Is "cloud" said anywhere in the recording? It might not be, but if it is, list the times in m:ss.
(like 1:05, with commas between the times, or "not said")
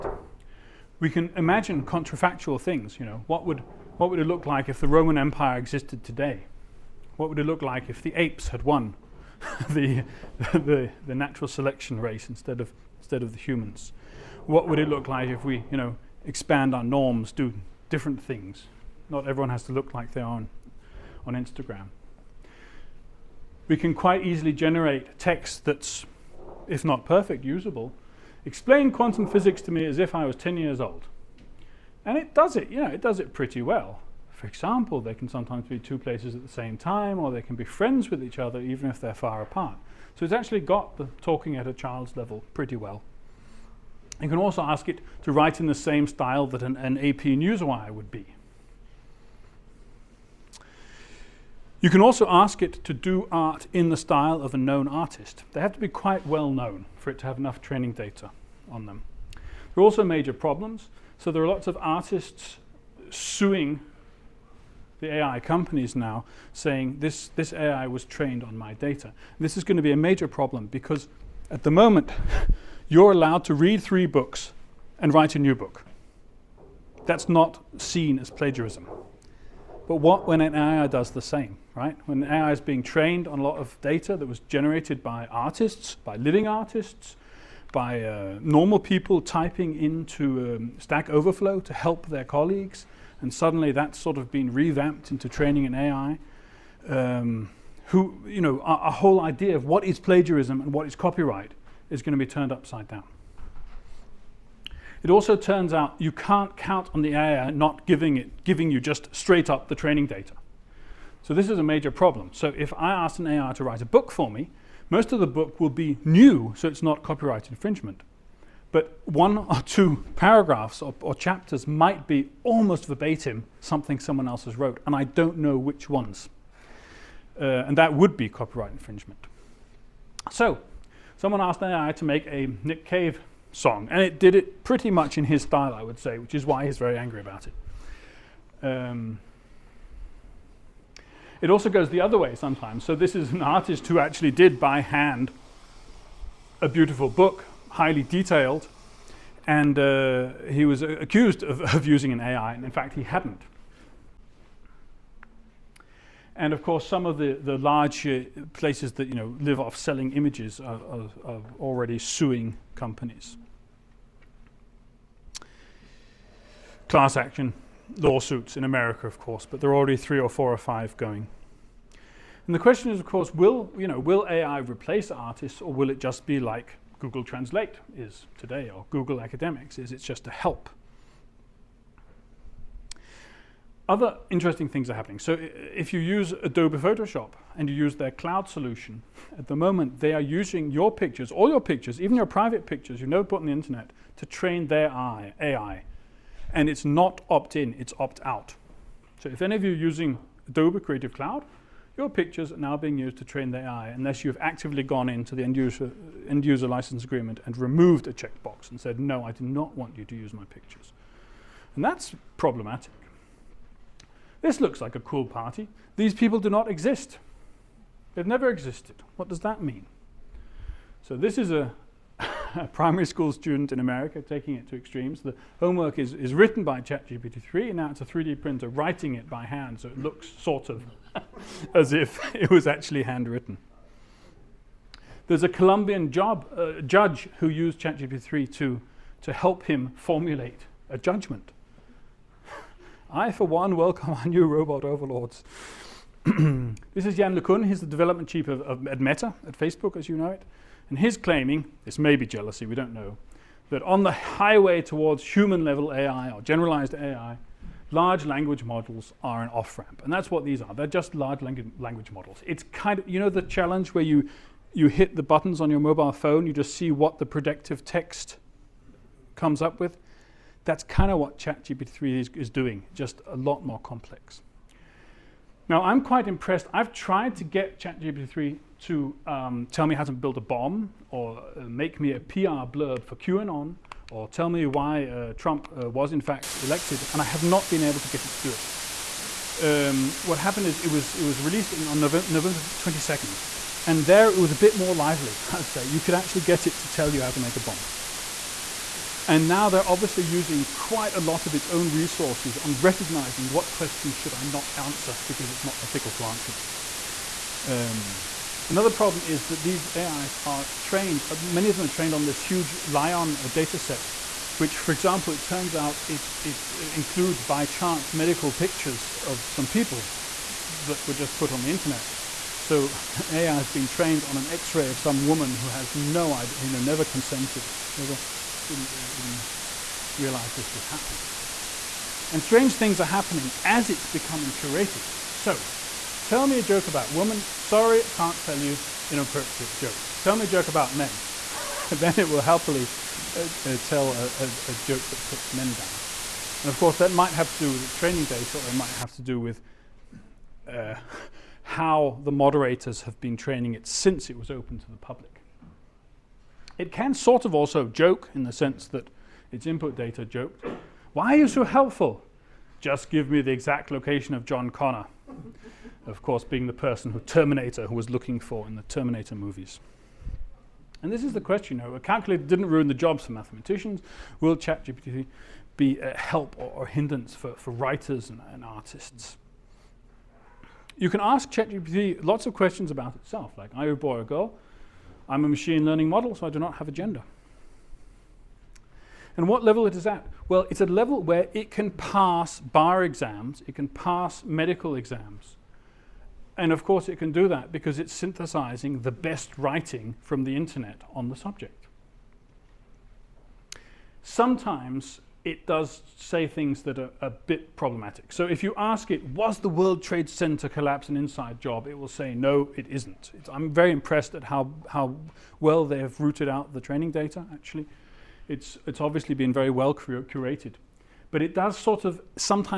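3:08, 3:21.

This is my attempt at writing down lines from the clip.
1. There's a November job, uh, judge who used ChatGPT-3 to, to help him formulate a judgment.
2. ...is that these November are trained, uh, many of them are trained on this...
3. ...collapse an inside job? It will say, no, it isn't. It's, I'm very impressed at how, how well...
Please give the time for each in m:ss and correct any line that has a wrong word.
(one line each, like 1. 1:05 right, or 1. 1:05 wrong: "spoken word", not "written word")
1. 3:55 wrong: "Colombian", not "November"
2. 5:09 wrong: "AIs", not "November"
3. 6:50 right.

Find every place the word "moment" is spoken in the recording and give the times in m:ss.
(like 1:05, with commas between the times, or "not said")
1:11, 3:09.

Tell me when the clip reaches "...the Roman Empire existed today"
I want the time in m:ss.
0:04.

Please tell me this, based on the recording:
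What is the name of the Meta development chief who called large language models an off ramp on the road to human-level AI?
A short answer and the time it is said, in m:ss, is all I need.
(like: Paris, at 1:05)
Jan LeCun, at 4:07.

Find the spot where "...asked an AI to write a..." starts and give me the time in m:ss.
1:52.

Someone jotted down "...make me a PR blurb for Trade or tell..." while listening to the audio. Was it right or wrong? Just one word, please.
wrong.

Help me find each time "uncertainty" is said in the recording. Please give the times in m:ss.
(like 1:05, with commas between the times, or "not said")
not said.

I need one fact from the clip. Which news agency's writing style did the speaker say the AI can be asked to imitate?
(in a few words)
AP Newswire.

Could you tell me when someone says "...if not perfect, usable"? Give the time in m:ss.
0:26.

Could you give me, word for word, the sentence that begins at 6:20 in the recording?
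You can ask ChatGPT lots of questions about itself, like are you a boy or a girl?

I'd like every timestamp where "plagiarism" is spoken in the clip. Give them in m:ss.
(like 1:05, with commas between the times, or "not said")
1:18, 1:39.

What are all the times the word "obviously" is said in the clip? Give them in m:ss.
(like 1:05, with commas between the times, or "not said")
4:59, 6:58.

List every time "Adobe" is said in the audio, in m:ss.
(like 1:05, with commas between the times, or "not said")
3:06, 3:20.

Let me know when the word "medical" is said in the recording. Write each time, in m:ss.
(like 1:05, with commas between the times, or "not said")
5:18, 6:34.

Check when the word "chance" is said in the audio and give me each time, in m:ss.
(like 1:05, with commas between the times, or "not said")
5:17.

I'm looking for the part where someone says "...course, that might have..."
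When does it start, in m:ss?
5:46.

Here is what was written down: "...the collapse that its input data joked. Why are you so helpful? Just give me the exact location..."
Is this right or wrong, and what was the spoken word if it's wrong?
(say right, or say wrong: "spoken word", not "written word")
wrong: "sense", not "collapse".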